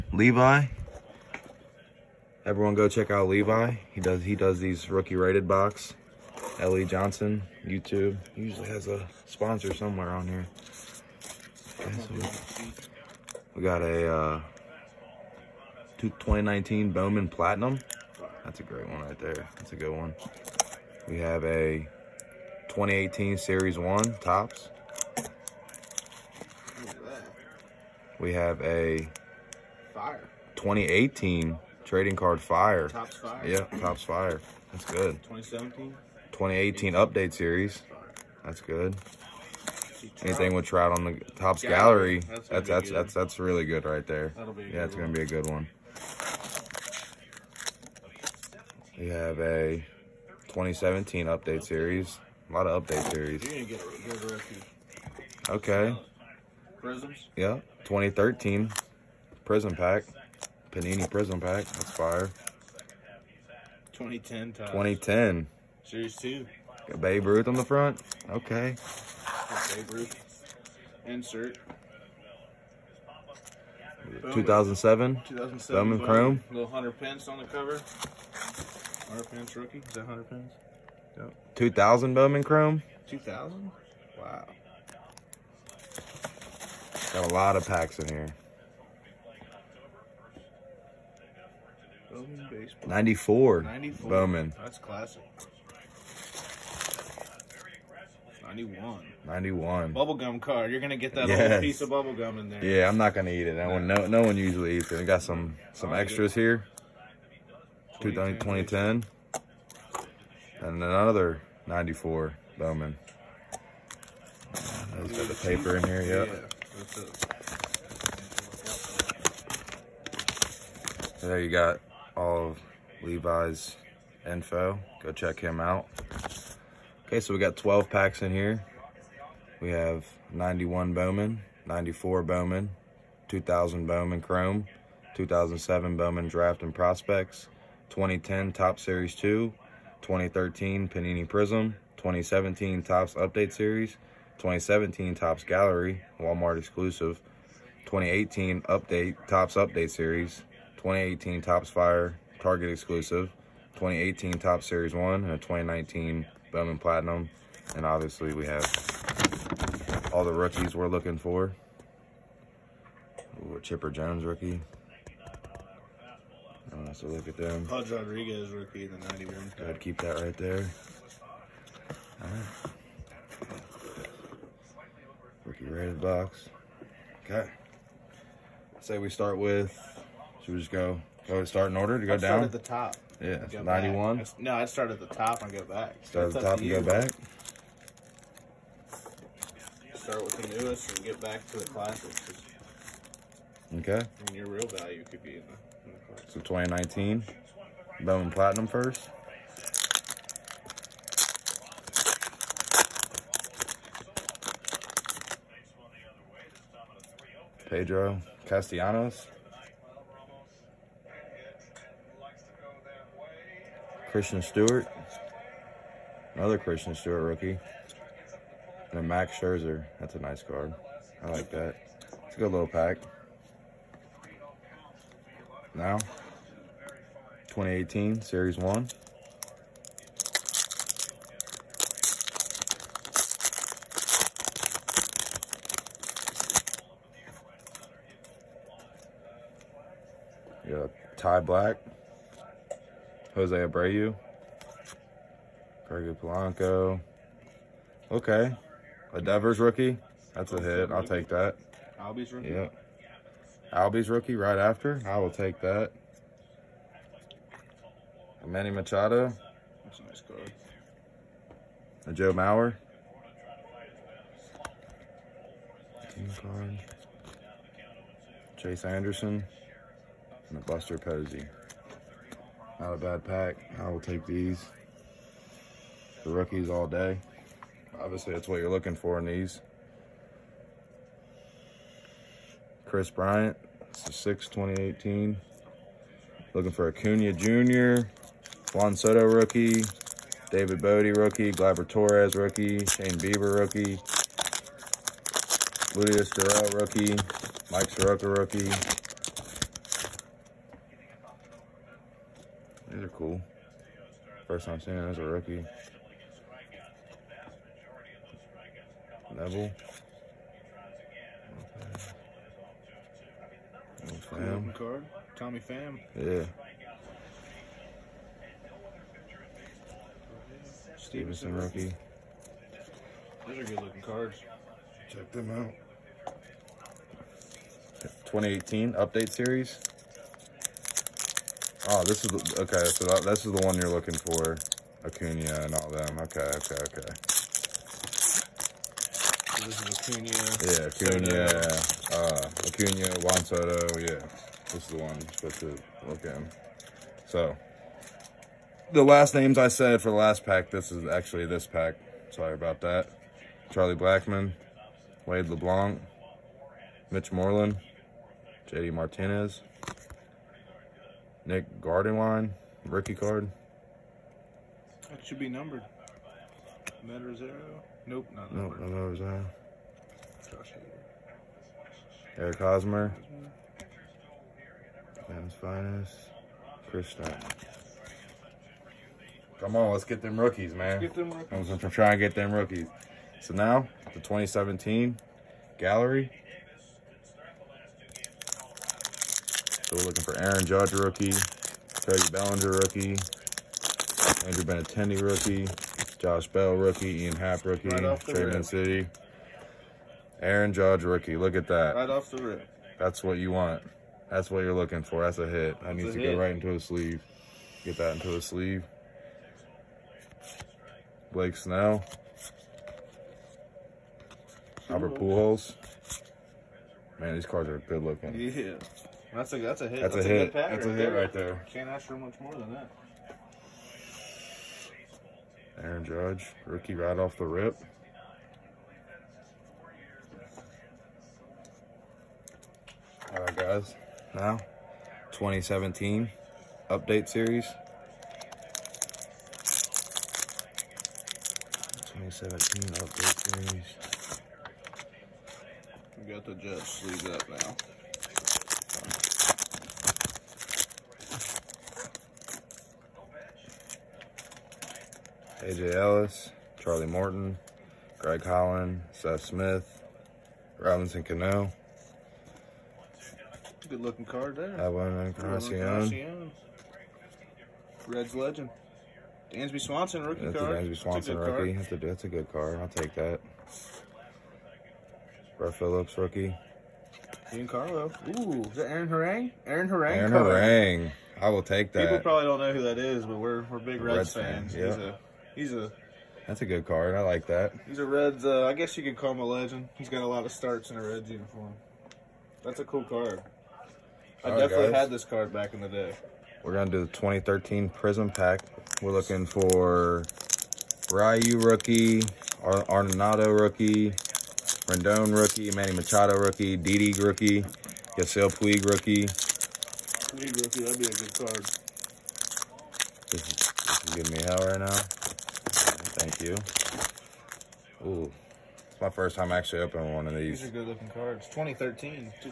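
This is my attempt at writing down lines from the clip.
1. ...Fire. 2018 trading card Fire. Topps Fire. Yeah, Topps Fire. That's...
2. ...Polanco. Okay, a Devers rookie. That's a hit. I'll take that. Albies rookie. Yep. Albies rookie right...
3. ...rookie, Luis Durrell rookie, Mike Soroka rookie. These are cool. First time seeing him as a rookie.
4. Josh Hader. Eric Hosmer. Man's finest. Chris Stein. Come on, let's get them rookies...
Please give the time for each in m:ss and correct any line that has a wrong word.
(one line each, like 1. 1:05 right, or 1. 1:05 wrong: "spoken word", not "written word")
1. 0:29 right
2. 4:06 right
3. 4:53 right
4. 6:10 right.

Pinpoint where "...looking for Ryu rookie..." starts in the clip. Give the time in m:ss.
8:19.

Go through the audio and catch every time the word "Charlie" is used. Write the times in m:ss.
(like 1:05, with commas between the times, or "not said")
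5:53, 7:36.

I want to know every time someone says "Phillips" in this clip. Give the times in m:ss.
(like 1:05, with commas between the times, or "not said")
7:55.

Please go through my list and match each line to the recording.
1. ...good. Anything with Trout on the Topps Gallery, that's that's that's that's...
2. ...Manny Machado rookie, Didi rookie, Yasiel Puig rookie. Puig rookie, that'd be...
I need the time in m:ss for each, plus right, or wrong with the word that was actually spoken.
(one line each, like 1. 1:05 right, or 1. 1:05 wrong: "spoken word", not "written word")
1. 0:38 right
2. 8:25 right.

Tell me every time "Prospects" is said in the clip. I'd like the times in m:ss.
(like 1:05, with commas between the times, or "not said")
2:16.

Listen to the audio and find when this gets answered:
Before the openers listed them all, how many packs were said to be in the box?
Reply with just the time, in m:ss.
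2:07.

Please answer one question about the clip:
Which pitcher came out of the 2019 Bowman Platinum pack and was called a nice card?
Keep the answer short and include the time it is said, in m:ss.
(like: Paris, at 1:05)
Max Scherzer, at 3:39.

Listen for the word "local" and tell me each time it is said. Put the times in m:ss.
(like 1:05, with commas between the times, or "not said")
not said.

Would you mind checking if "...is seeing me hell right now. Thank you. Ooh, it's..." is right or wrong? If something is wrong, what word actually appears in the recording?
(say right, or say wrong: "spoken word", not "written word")
wrong: "giving", not "seeing".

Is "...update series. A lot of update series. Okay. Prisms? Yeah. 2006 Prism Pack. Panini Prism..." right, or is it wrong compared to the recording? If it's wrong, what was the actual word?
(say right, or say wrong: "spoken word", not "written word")
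wrong: "2013", not "2006".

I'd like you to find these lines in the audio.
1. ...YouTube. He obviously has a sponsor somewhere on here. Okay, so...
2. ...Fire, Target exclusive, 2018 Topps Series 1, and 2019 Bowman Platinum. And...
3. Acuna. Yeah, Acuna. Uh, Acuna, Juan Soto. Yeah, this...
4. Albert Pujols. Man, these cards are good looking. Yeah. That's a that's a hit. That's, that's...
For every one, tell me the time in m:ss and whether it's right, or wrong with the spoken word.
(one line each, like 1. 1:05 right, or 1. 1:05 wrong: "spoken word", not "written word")
1. 0:07 wrong: "usually", not "obviously"
2. 2:31 right
3. 5:39 right
4. 6:54 right.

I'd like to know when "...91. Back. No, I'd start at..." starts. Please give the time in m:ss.
3:03.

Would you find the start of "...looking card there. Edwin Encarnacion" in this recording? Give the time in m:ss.
7:44.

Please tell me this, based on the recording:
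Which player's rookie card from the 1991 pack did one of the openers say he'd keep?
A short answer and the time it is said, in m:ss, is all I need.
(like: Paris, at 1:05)
Pudge Rodriguez, at 2:47.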